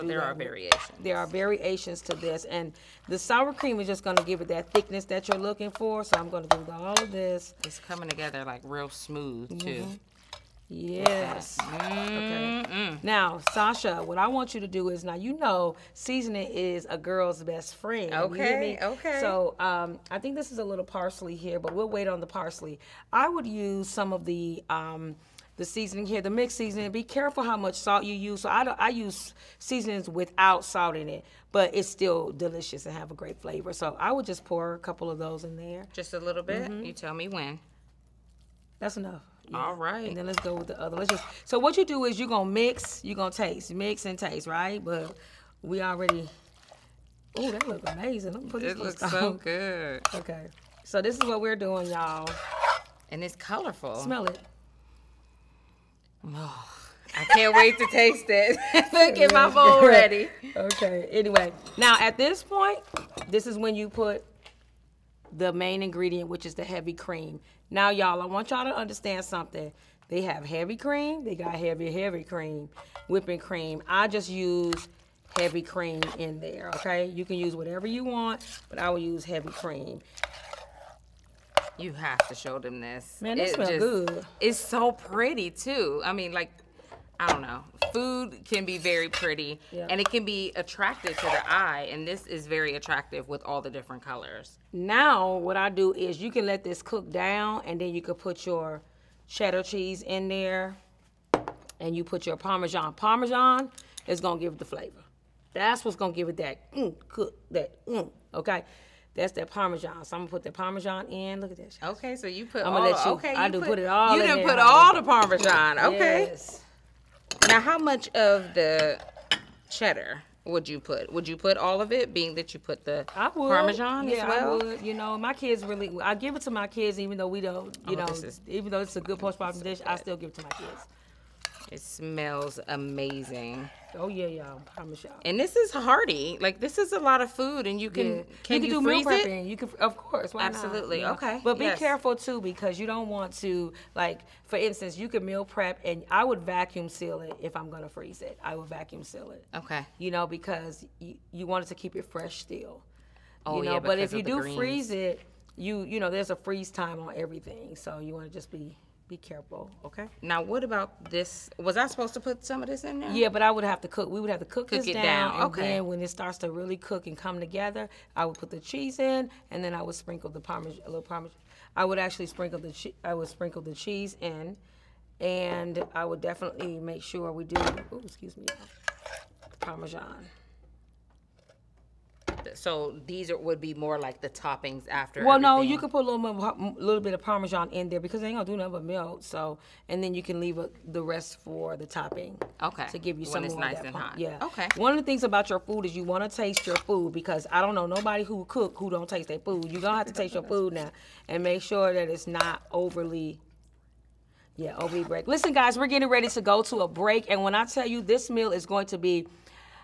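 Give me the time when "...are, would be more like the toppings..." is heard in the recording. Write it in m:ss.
3:03.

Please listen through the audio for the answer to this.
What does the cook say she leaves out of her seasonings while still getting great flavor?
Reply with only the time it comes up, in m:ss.
0:30.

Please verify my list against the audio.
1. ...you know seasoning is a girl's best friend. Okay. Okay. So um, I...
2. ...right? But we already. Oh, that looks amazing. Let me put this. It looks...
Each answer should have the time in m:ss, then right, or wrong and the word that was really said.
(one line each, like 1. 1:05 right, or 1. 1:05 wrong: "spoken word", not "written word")
1. 0:15 right
2. 0:44 right.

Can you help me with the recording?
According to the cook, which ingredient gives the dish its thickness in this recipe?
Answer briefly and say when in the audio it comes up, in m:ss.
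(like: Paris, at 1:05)
sour cream, at 0:03.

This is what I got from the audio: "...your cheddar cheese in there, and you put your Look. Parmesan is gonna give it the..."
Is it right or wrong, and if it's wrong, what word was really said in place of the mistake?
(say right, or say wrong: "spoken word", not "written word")
wrong: "Parmesan", not "Look".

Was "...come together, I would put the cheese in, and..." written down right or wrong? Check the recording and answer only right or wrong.
right.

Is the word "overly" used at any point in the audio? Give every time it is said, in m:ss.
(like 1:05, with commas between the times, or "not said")
3:22.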